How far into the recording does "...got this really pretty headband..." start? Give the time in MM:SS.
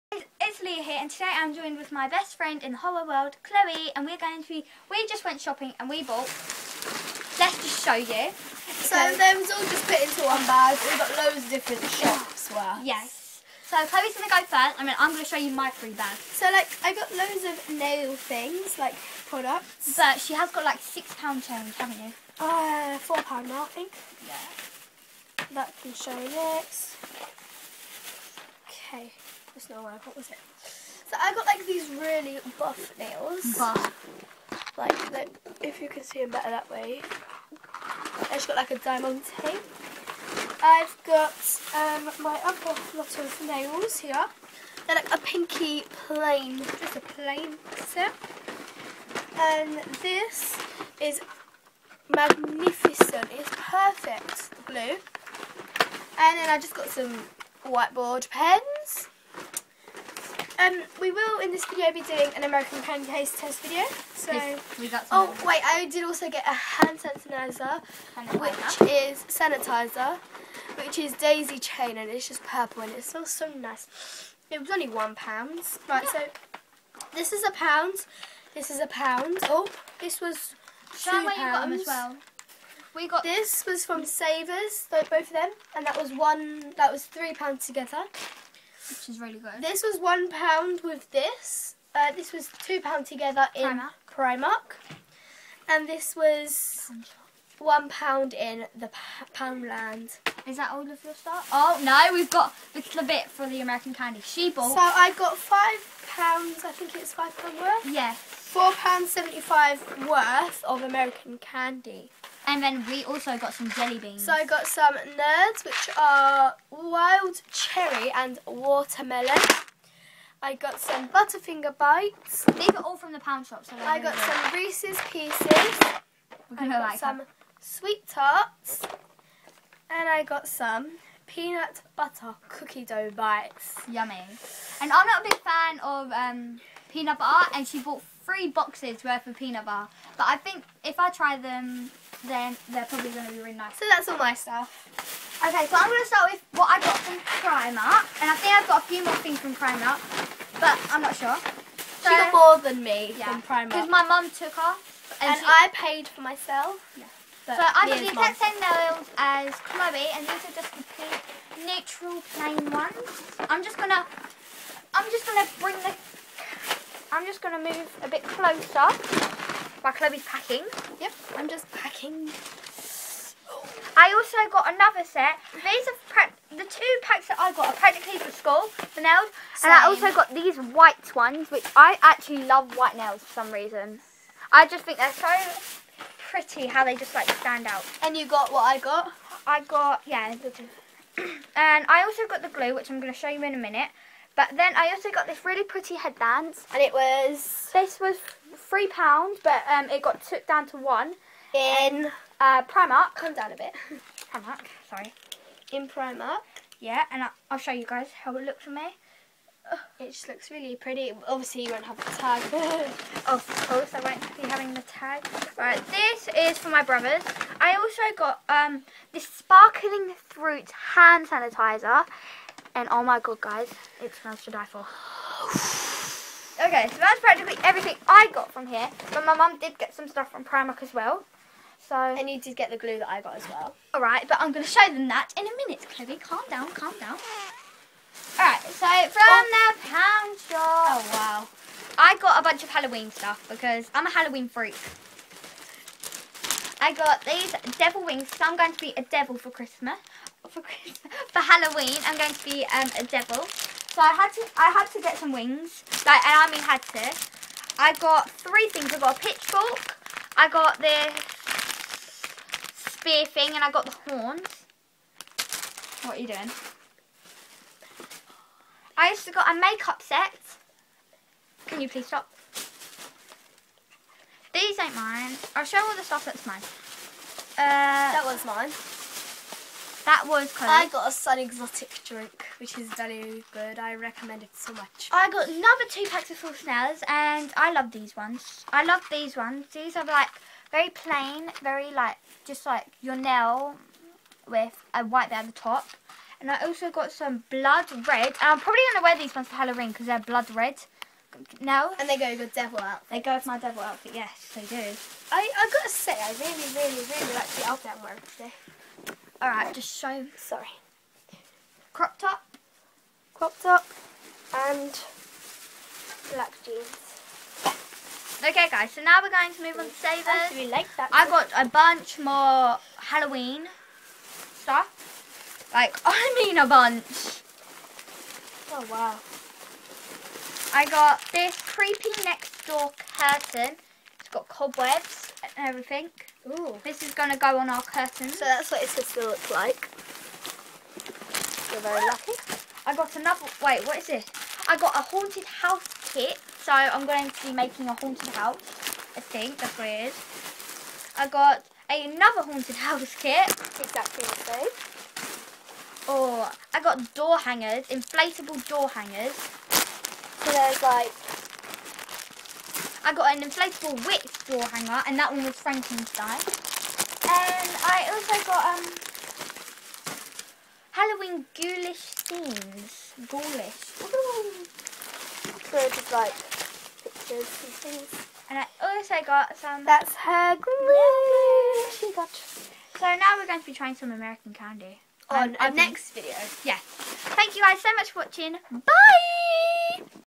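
03:15.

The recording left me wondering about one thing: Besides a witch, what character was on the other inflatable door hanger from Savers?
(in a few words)
Frankenstein.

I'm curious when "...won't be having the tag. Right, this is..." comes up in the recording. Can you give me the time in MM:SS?
03:33.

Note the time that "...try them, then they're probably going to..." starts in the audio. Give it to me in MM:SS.
02:21.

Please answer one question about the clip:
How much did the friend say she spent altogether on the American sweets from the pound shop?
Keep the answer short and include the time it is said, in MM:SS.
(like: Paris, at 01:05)
£4.75, at 01:48.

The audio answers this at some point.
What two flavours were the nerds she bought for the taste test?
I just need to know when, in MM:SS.
01:56.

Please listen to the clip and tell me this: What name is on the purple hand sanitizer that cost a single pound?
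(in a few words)
Daisy Chain.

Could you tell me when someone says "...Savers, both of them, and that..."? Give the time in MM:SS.
01:24.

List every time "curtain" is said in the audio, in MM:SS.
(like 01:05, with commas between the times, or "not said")
05:33, 05:37.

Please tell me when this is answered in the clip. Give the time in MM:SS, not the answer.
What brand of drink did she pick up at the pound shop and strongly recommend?
04:41.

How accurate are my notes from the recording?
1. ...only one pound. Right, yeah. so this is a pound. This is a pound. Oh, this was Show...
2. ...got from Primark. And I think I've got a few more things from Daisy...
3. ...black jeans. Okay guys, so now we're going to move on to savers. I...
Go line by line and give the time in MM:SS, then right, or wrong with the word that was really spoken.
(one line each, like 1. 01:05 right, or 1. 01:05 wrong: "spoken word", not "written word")
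1. 01:14 right
2. 02:26 wrong: "Primark", not "Daisy"
3. 05:16 right.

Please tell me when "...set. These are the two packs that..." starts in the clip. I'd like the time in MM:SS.
02:55.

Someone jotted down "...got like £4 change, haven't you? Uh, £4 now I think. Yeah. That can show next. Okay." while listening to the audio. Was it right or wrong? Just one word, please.
wrong.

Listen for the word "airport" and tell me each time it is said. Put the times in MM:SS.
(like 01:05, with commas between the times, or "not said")
not said.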